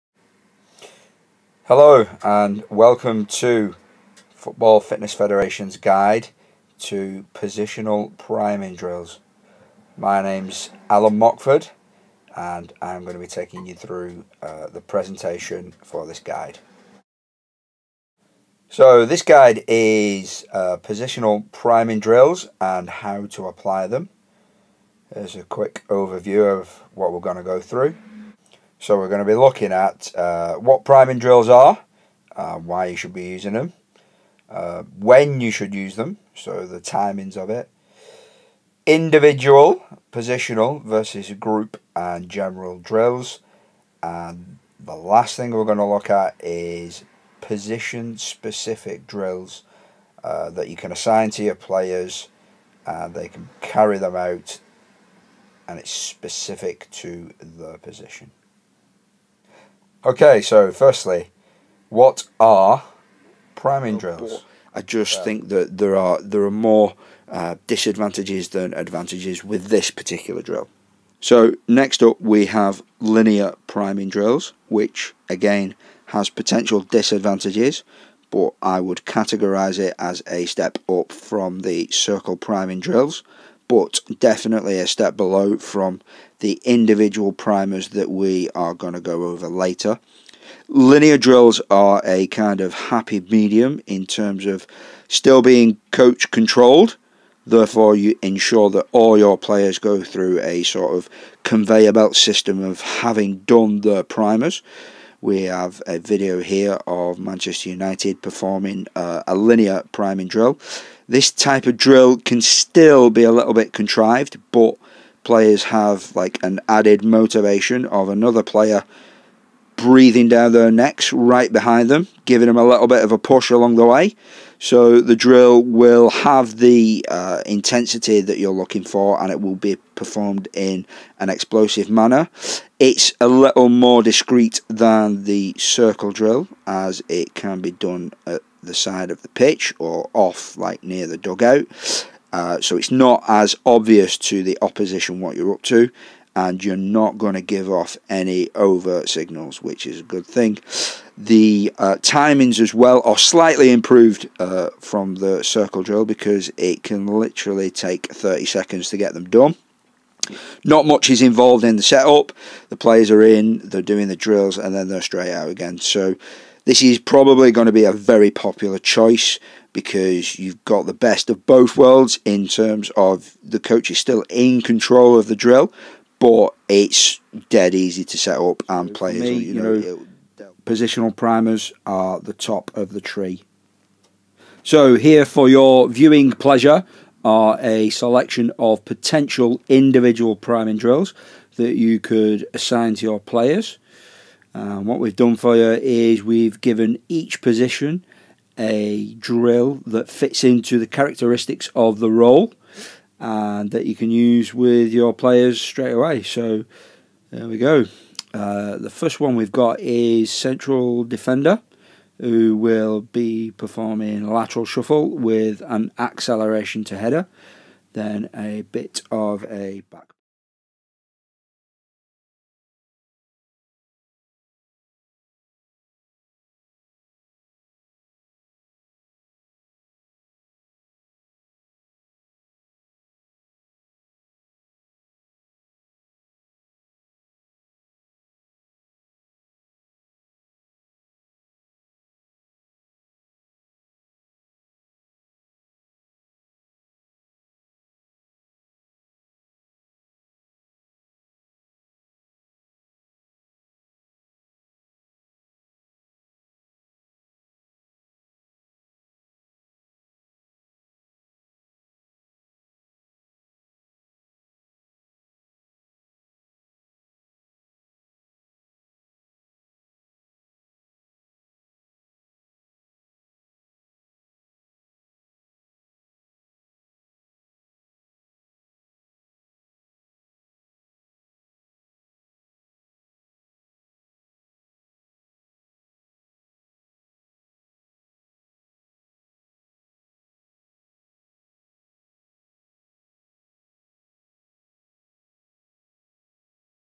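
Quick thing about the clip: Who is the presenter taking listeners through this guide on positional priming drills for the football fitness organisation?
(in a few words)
Alan Mockford.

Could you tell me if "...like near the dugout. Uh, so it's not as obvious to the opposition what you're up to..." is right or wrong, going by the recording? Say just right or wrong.
right.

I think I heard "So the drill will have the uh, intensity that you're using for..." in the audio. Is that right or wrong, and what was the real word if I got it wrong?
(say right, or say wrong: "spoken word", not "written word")
wrong: "looking", not "using".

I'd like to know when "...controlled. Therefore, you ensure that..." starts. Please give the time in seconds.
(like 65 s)
96 s.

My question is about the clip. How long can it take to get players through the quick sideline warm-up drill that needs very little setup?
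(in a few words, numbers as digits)
30 seconds.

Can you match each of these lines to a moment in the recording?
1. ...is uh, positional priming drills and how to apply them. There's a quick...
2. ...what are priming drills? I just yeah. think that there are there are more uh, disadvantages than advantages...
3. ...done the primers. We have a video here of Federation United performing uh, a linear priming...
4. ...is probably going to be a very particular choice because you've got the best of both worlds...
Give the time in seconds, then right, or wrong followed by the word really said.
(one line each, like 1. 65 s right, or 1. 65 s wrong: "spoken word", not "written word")
1. 19 s right
2. 61 s right
3. 103 s wrong: "Manchester", not "Federation"
4. 166 s wrong: "popular", not "particular".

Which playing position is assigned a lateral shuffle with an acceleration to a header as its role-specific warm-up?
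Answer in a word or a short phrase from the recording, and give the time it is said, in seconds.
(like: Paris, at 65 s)
Central defender, at 210 s.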